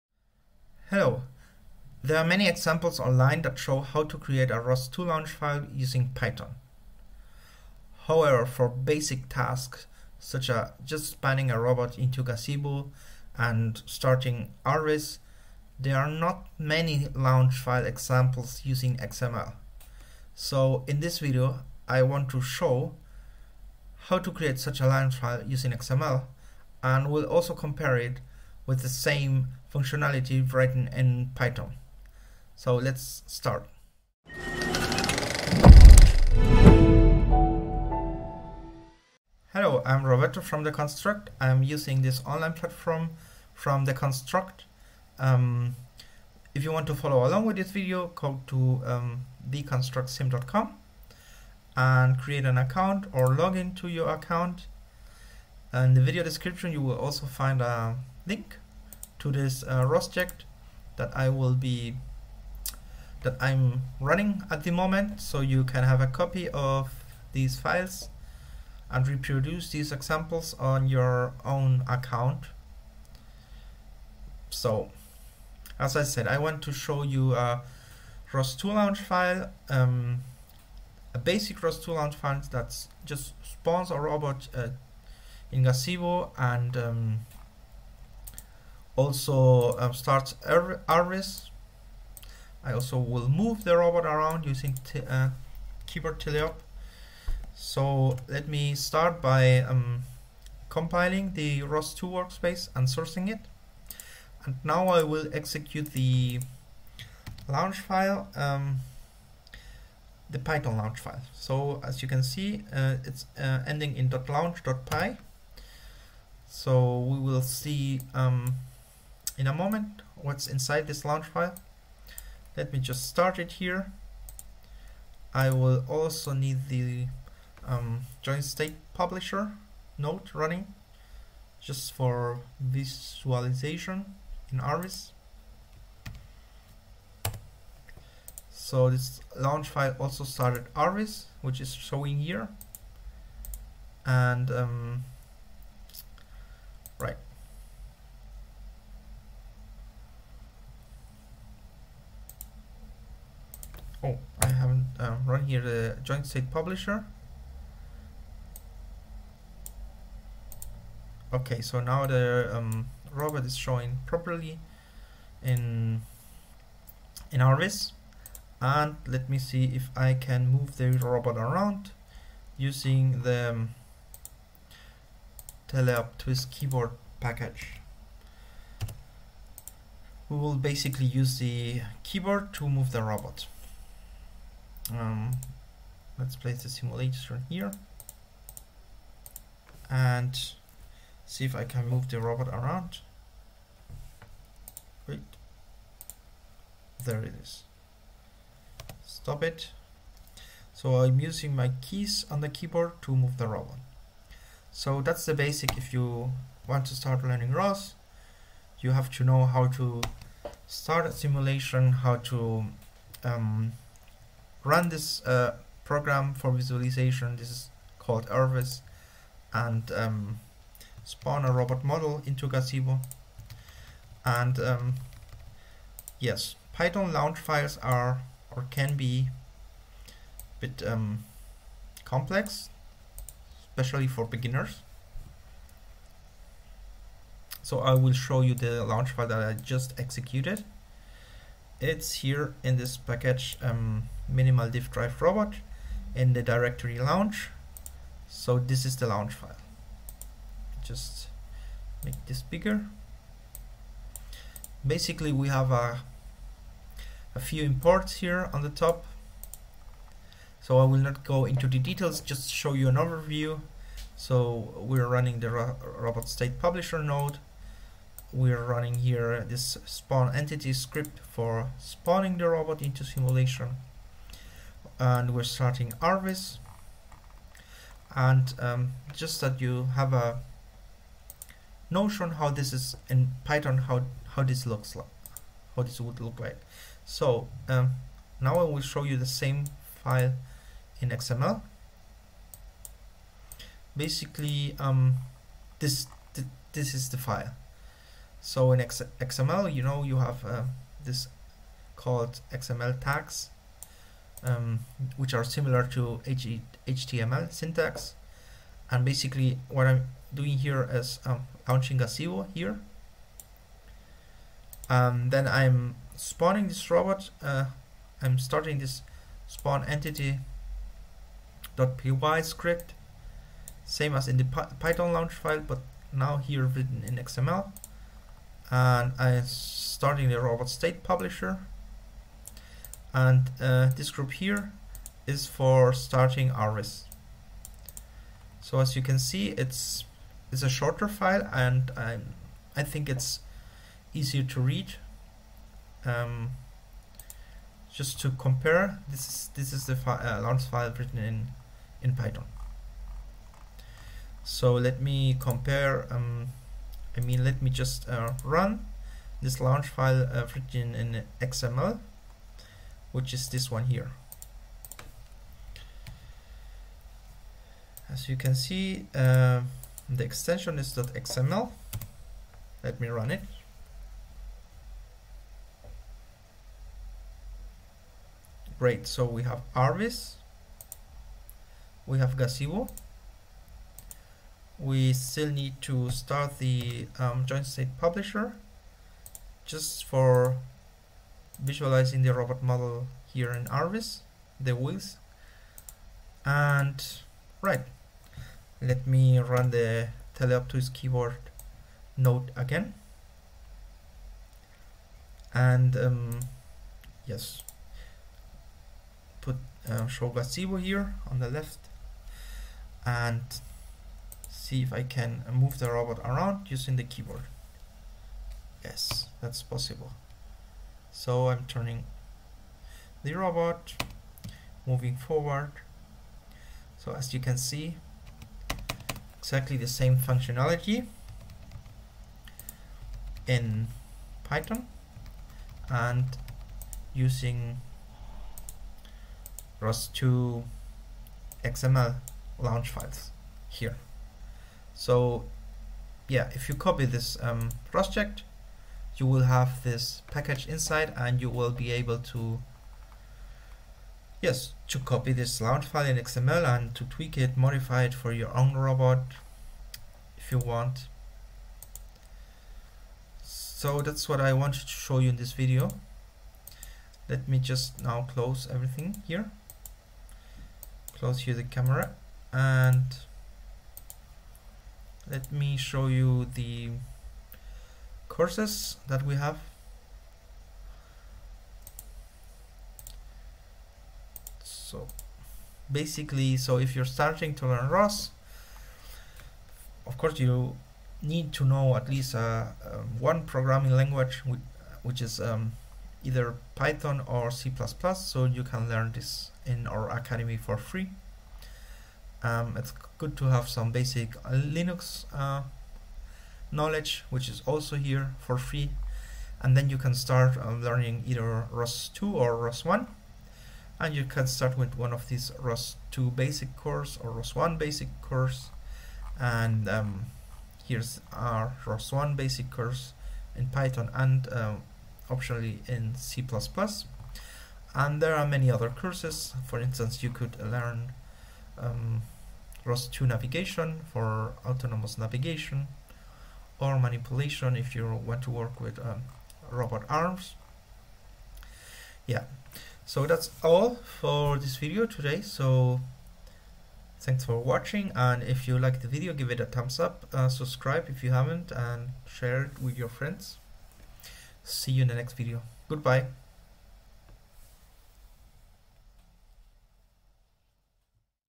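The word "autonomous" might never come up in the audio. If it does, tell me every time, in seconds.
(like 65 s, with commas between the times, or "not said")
534 s.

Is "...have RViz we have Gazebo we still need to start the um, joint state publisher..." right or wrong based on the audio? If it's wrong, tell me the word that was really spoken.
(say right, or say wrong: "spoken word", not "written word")
right.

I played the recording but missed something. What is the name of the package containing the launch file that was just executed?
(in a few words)
minimal diff drive robot.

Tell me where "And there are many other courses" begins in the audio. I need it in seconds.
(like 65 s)
527 s.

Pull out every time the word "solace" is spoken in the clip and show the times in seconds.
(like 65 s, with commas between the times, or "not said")
not said.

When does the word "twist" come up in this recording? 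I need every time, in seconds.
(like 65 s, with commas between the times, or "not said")
176 s, 400 s.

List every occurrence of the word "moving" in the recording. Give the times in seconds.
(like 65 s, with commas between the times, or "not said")
424 s.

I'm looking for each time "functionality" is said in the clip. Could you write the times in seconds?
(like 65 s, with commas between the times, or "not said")
29 s, 430 s.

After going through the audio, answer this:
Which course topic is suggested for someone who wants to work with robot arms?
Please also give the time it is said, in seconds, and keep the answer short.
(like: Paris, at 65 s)
manipulation, at 536 s.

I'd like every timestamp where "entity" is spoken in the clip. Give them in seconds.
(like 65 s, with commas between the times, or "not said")
270 s, 319 s.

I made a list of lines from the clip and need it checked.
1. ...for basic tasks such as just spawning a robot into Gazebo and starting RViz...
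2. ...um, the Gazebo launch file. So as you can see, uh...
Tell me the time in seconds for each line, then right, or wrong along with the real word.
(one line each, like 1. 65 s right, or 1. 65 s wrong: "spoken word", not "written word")
1. 8 s right
2. 108 s wrong: "Python", not "Gazebo".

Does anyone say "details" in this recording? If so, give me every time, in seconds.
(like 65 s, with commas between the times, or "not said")
261 s.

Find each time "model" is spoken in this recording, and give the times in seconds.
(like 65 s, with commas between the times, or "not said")
221 s, 392 s.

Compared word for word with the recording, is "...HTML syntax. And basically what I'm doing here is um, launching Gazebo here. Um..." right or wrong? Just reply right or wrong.
right.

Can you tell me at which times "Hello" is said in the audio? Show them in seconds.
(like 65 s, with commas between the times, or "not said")
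0 s, 39 s.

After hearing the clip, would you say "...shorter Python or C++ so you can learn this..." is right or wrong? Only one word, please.
wrong.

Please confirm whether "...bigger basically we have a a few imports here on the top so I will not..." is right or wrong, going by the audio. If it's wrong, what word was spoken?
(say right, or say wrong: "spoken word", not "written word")
right.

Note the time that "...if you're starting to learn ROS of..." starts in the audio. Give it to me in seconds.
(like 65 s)
486 s.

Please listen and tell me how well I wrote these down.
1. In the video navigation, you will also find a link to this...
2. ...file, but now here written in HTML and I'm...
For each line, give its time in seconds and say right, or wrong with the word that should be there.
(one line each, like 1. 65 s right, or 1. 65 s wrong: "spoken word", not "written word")
1. 55 s wrong: "description", not "navigation"
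2. 325 s wrong: "XML", not "HTML".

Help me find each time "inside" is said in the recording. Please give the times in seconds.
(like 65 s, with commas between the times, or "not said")
120 s, 450 s.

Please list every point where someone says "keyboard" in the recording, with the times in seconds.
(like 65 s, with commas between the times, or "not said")
95 s, 176 s, 182 s, 202 s, 400 s, 417 s.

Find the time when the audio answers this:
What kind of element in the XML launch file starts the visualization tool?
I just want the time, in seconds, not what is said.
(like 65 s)
334 s.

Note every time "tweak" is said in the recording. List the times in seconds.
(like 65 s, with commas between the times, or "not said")
457 s.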